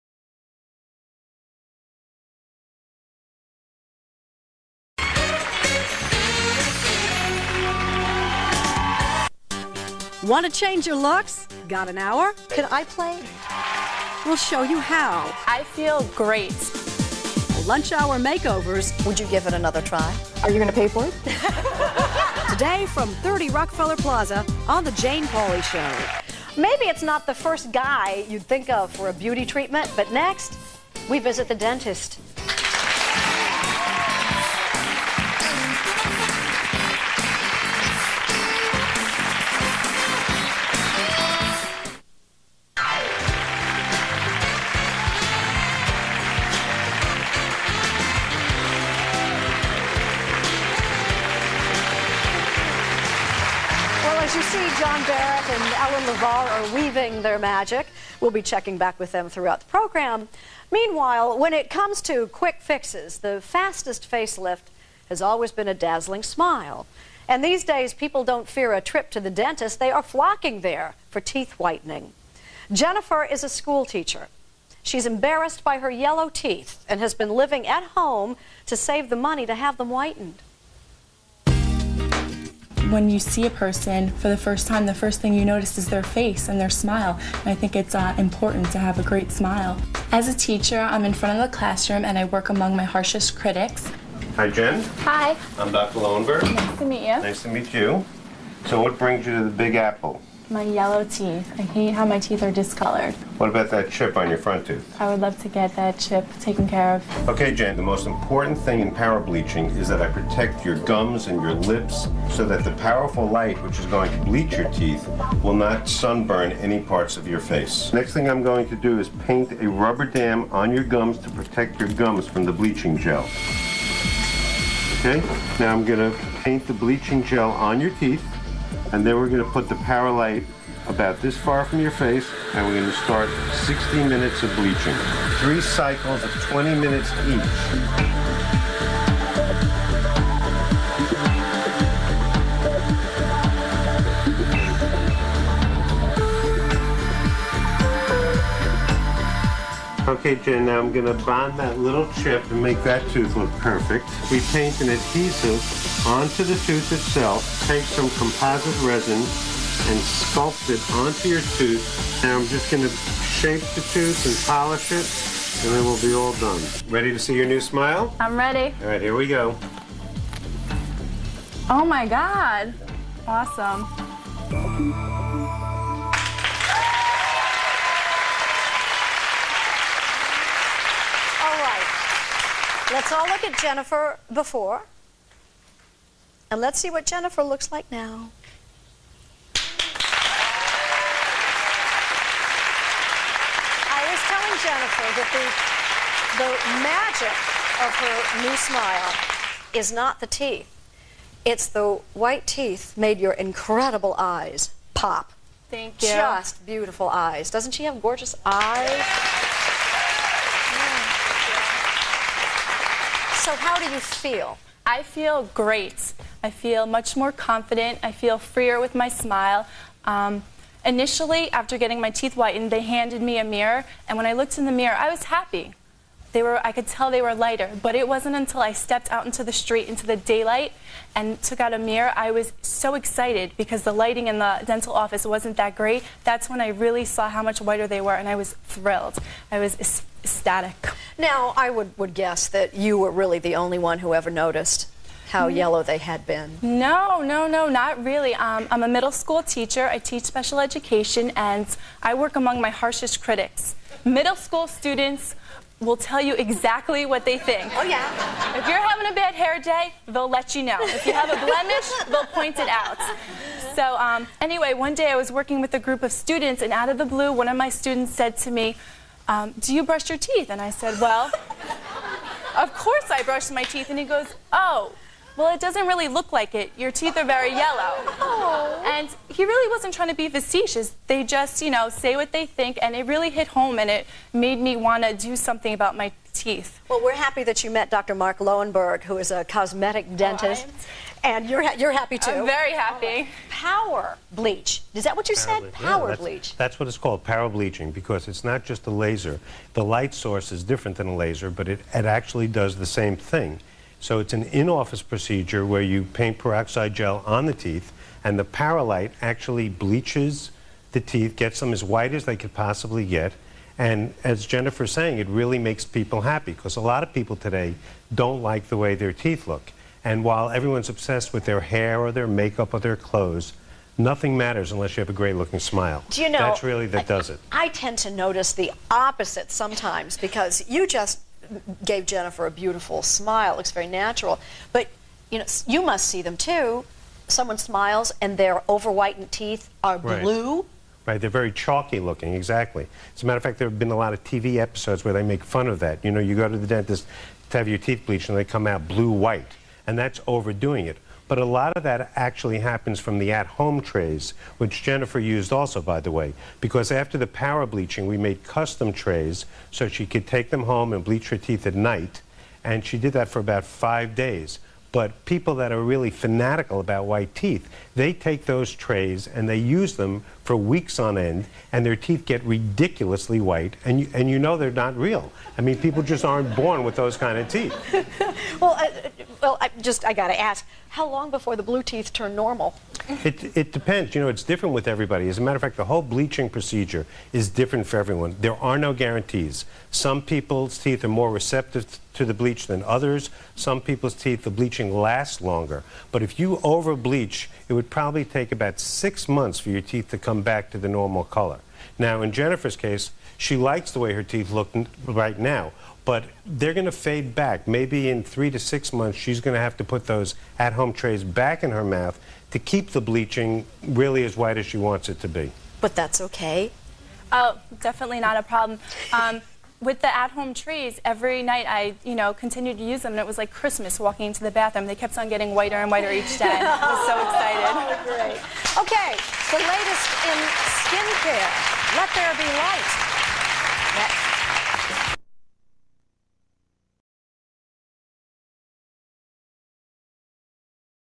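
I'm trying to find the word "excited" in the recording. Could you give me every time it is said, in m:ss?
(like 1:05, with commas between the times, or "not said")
3:52, 7:07.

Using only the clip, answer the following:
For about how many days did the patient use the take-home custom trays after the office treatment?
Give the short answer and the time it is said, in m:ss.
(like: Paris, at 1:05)
5 days, at 6:03.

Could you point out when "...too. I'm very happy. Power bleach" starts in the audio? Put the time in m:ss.
4:52.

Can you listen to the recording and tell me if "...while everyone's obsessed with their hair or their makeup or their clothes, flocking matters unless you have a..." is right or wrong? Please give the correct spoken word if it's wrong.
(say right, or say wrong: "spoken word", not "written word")
wrong: "nothing", not "flocking".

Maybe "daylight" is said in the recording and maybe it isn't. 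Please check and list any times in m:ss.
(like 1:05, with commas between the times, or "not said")
3:50.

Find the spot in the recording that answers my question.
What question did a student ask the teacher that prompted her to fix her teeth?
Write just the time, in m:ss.
4:29.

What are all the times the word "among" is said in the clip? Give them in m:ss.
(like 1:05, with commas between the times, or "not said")
1:32, 4:12.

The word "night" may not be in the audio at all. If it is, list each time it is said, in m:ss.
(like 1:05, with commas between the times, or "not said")
6:01, 7:01.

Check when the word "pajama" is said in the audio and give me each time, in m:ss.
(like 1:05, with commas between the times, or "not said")
not said.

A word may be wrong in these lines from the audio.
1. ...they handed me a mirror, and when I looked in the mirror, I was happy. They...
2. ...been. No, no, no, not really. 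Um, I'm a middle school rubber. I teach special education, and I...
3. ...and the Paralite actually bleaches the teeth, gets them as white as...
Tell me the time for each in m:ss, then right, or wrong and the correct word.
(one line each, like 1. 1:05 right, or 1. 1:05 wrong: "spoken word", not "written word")
1. 3:42 right
2. 4:06 wrong: "teacher", not "rubber"
3. 5:08 right.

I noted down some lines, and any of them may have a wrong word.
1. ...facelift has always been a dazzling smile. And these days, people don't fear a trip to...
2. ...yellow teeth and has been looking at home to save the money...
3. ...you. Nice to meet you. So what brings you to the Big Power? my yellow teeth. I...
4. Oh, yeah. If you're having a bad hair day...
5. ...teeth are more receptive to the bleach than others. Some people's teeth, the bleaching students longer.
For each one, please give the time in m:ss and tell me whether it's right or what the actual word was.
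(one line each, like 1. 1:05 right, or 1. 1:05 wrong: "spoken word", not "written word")
1. 1:04 right
2. 1:15 wrong: "living", not "looking"
3. 1:37 wrong: "Apple", not "Power"
4. 4:17 right
5. 6:30 wrong: "lasts", not "students".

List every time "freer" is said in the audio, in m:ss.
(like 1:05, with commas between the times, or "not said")
3:38.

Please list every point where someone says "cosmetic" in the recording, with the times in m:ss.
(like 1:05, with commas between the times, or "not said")
4:49.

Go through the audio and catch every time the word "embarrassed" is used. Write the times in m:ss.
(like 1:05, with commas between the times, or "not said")
1:15.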